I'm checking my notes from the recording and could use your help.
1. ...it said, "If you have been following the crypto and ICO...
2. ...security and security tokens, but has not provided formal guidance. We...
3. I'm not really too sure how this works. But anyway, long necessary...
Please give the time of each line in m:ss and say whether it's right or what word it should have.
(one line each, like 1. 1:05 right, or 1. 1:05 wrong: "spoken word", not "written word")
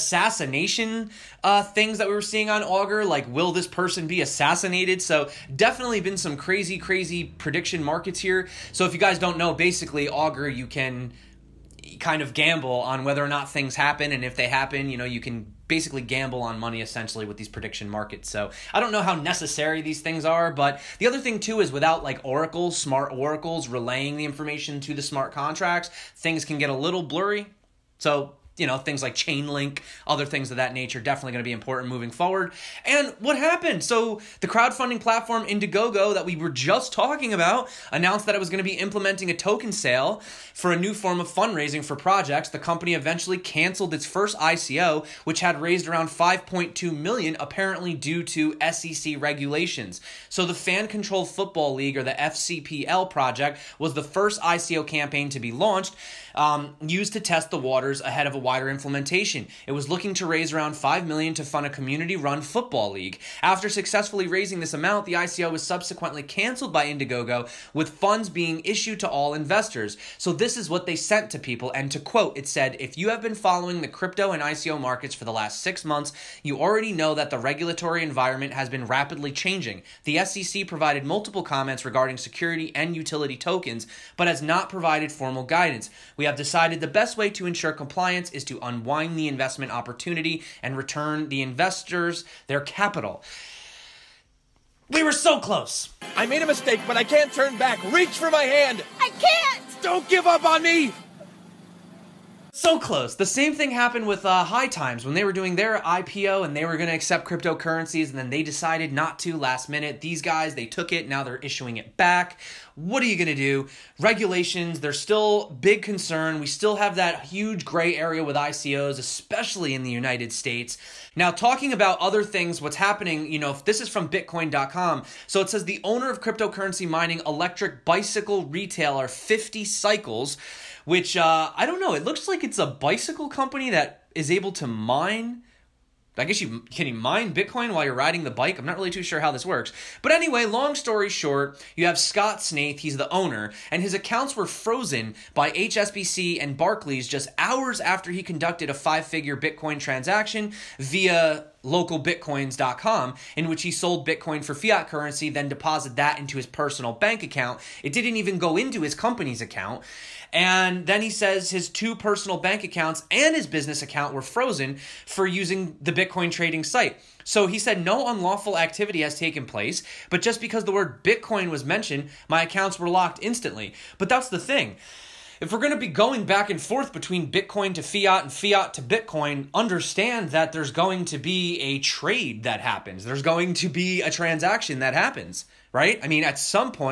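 1. 1:12 right
2. 1:22 wrong: "utility", not "security"
3. 2:18 wrong: "story", not "necessary".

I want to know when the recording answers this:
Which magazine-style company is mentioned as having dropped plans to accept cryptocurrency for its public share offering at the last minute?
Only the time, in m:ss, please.
1:44.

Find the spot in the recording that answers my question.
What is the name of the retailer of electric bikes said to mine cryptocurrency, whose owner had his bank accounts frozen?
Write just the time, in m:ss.
2:09.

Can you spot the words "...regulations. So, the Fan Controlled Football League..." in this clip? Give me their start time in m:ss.
0:49.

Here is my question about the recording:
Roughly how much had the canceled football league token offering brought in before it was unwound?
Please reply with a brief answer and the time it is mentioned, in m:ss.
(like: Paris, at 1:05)
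5.2 million, at 0:46.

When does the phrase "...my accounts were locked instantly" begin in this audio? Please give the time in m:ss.
2:52.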